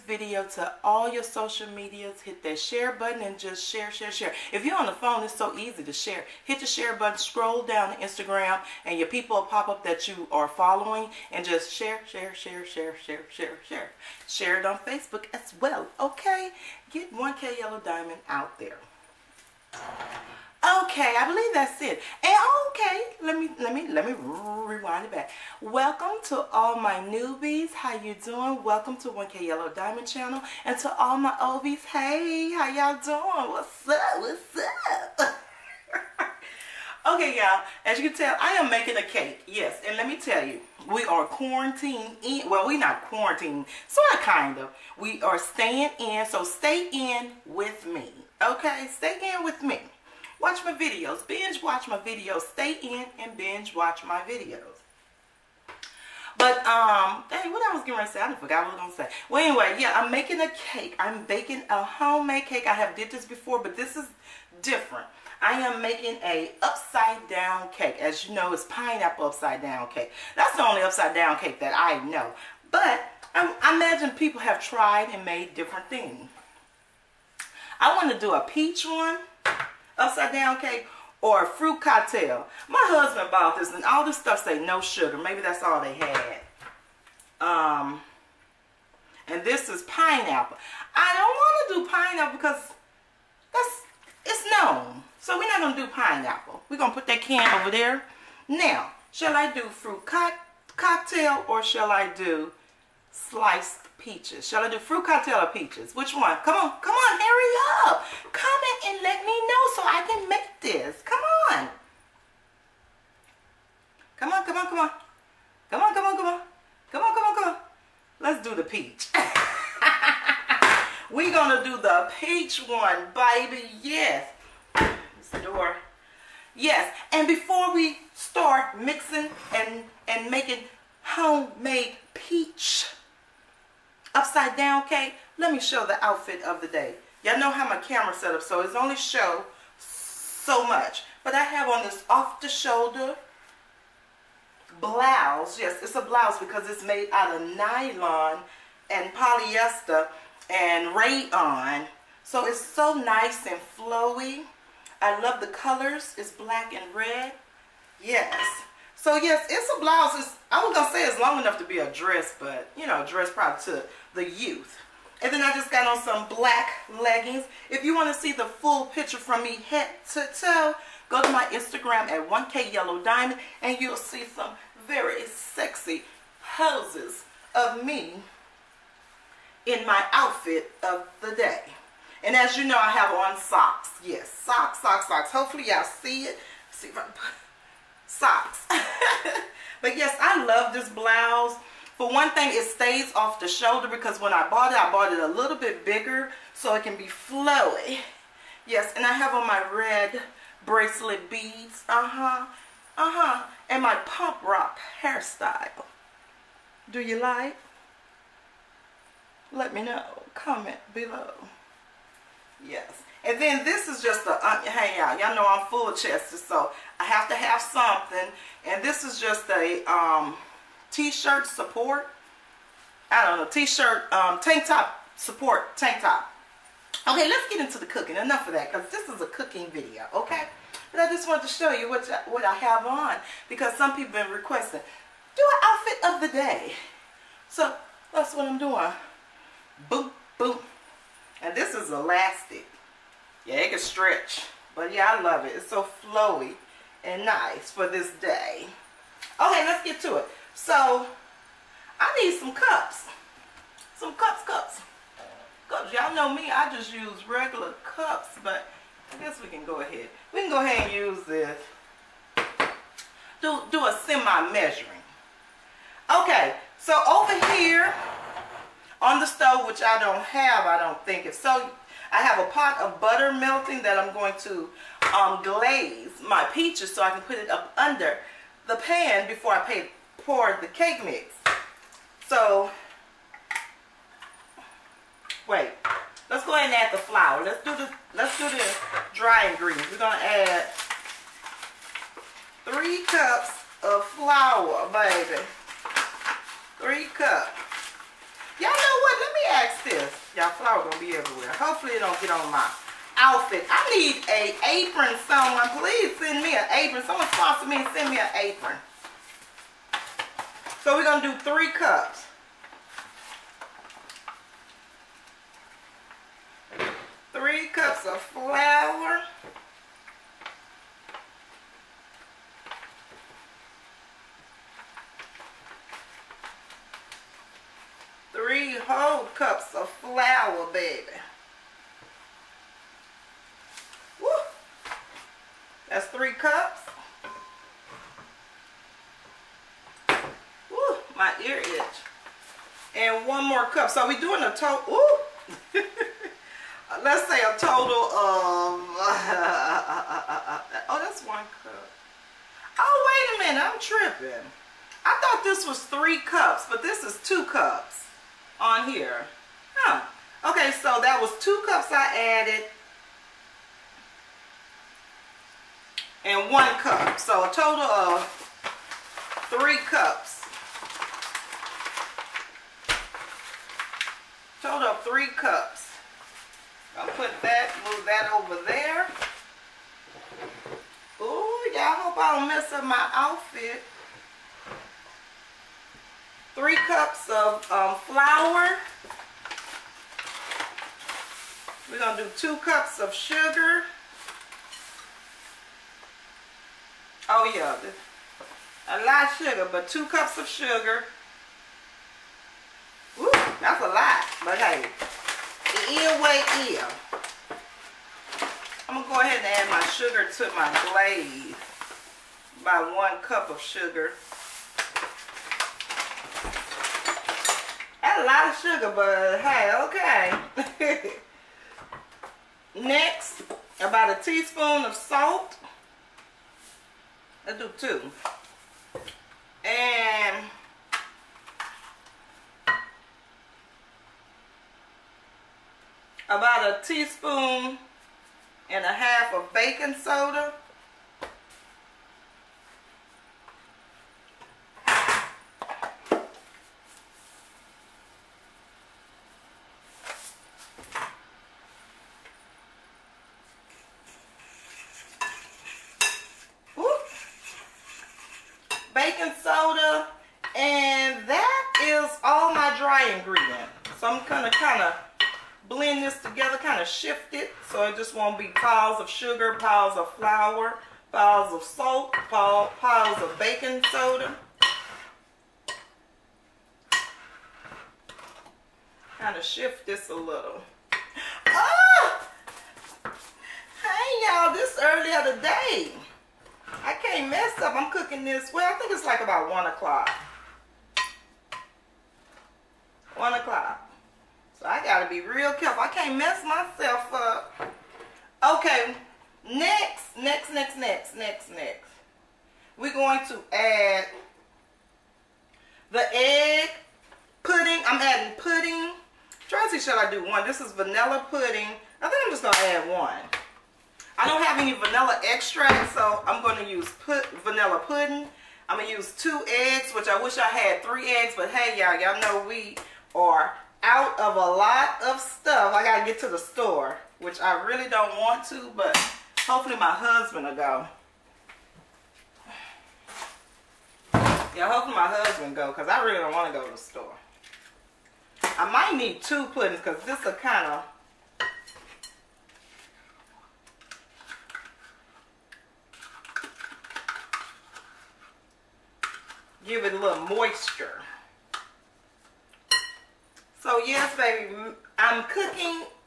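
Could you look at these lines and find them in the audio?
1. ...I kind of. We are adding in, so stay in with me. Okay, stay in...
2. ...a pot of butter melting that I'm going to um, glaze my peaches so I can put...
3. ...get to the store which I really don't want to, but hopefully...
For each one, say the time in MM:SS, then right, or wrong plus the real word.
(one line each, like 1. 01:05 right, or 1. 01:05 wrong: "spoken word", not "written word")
1. 00:44 wrong: "staying", not "adding"
2. 04:32 right
3. 08:46 right.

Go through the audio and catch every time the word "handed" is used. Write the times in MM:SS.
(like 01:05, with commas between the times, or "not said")
not said.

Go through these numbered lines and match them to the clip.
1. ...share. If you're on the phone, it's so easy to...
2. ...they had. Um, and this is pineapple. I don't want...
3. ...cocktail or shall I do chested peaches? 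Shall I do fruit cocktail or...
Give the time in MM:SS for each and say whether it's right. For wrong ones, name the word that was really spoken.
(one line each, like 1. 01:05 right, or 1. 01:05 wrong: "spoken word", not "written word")
1. 00:04 right
2. 01:25 right
3. 01:40 wrong: "sliced", not "chested".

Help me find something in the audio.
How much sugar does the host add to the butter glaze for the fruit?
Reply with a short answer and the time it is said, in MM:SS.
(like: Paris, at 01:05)
1 cup, at 06:52.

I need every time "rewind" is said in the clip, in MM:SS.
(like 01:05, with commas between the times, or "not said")
00:24.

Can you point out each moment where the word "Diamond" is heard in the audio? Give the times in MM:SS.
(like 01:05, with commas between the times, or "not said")
00:17, 00:29, 02:53.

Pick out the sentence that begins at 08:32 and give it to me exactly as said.
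I think I'm just going to add one.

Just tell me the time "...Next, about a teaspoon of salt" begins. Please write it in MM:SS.
07:02.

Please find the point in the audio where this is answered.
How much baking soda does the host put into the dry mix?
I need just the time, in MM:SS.
07:16.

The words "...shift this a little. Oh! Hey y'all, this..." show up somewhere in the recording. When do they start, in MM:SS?
07:59.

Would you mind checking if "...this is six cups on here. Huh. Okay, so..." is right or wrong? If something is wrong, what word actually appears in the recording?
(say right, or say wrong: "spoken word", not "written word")
wrong: "two", not "six".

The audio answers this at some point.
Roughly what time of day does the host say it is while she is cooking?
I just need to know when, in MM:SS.
08:09.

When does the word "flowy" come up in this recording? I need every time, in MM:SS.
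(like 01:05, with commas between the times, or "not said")
02:33, 03:17, 04:06.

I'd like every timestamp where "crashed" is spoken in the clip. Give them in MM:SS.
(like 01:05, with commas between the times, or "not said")
not said.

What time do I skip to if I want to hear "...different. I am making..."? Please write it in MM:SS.
01:04.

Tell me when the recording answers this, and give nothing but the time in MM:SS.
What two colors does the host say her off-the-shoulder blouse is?
02:36.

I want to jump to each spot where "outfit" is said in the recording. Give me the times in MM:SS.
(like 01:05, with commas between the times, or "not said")
02:16, 03:00, 03:55, 05:03, 06:23.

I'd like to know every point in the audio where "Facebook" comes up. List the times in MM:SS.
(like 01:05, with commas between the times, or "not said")
00:14.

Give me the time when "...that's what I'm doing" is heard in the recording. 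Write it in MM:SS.
03:58.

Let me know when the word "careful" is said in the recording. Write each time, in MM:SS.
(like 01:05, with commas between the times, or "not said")
08:15.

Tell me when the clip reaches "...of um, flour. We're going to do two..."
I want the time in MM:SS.
06:27.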